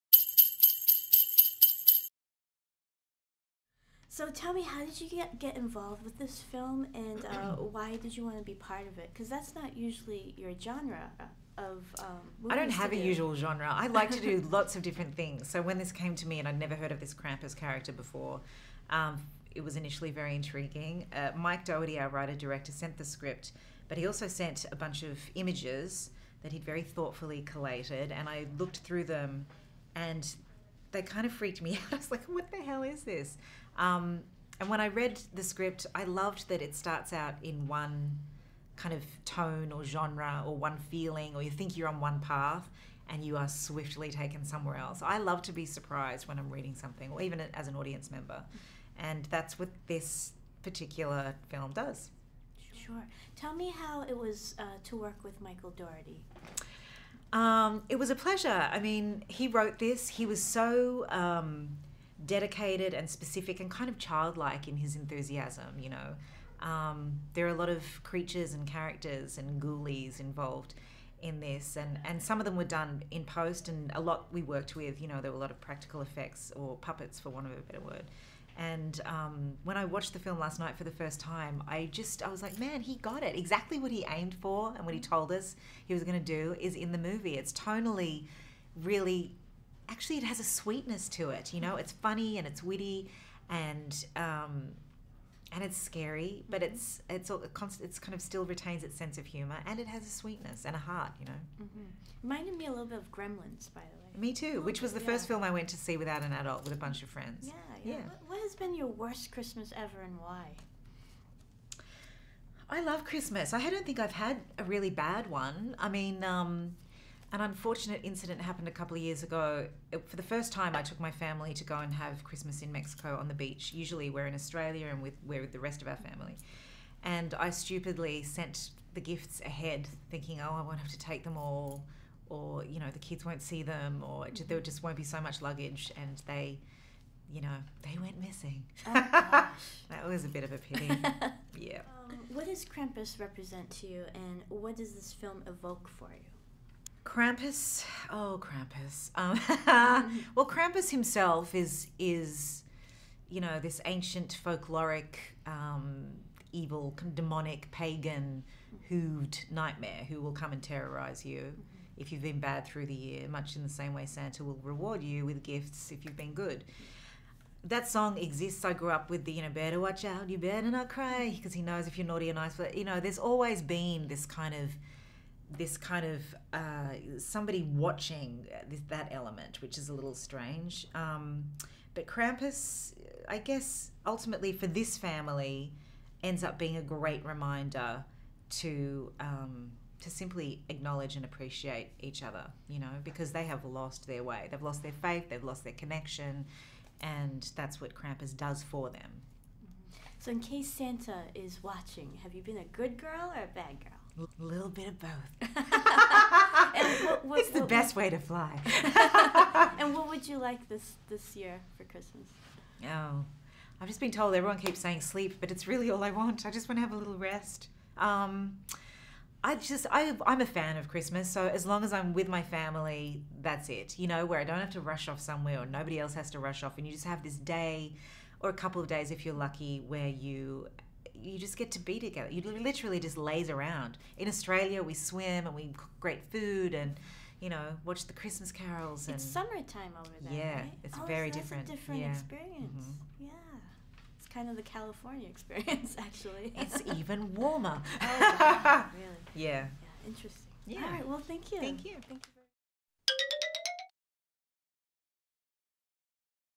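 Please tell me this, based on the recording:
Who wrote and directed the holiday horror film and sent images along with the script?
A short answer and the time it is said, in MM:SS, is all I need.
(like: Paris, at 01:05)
Mike Doherty, at 00:21.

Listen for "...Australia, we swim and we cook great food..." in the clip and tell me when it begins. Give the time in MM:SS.
03:54.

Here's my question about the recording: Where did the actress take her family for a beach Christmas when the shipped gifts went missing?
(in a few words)
Mexico.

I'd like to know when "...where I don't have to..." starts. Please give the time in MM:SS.
03:44.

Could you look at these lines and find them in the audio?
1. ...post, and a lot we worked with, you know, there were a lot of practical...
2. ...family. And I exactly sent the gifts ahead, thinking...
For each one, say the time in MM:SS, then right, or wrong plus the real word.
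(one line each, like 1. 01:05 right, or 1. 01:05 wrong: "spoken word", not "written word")
1. 01:13 right
2. 02:05 wrong: "stupidly", not "exactly".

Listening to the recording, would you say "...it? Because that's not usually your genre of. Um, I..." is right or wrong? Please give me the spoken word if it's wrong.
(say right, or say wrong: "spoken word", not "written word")
right.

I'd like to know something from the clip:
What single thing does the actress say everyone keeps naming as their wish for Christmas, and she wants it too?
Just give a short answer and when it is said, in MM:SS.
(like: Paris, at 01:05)
Sleep, at 03:35.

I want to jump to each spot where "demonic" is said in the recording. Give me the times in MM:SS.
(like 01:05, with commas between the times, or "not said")
02:37.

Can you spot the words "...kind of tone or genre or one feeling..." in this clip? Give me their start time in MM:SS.
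00:38.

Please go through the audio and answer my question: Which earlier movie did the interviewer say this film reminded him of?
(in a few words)
Gremlins.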